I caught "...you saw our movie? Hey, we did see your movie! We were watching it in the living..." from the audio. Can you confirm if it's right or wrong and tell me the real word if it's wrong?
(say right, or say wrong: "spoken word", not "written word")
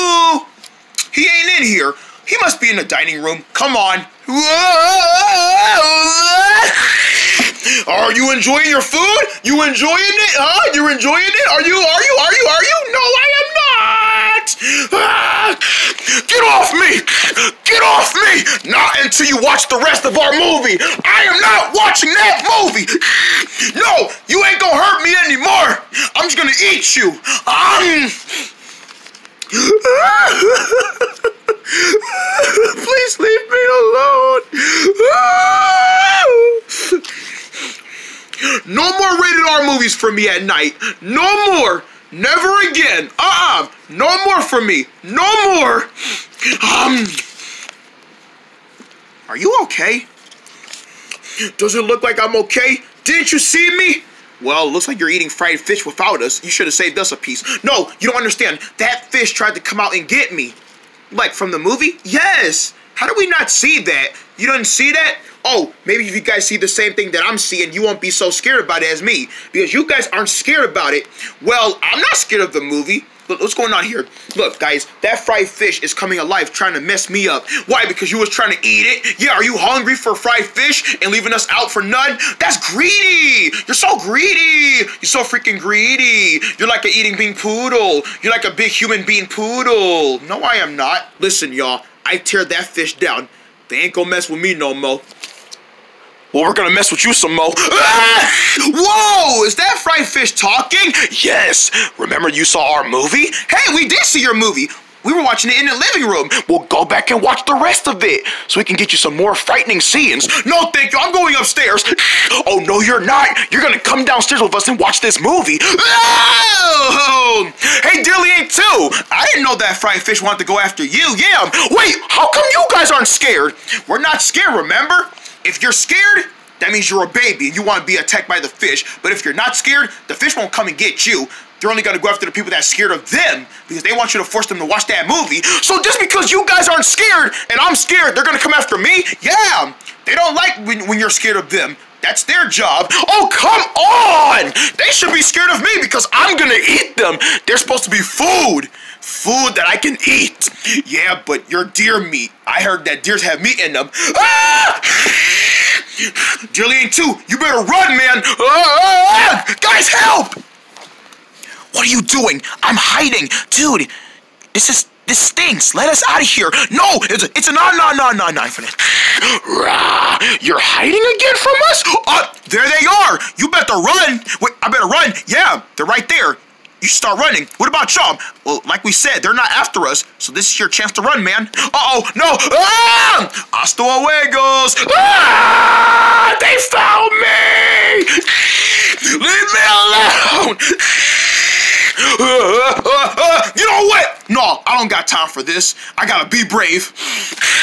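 right.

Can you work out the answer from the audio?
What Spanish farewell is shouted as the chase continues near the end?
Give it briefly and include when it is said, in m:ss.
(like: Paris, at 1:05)
Hasta luego, at 3:03.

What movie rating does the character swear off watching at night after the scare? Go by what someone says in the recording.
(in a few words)
Rated R.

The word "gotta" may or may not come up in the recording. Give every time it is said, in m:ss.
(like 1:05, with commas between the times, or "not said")
3:16.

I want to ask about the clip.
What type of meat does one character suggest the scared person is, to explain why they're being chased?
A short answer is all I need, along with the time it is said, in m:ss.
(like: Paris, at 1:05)
Deer meat, at 2:31.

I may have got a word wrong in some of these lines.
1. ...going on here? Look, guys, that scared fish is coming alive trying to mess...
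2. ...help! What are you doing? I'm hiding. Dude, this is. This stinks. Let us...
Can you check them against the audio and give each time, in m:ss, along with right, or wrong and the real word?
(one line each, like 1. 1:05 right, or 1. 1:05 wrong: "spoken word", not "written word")
1. 1:13 wrong: "fried", not "scared"
2. 2:39 right.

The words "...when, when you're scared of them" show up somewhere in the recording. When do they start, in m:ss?
2:20.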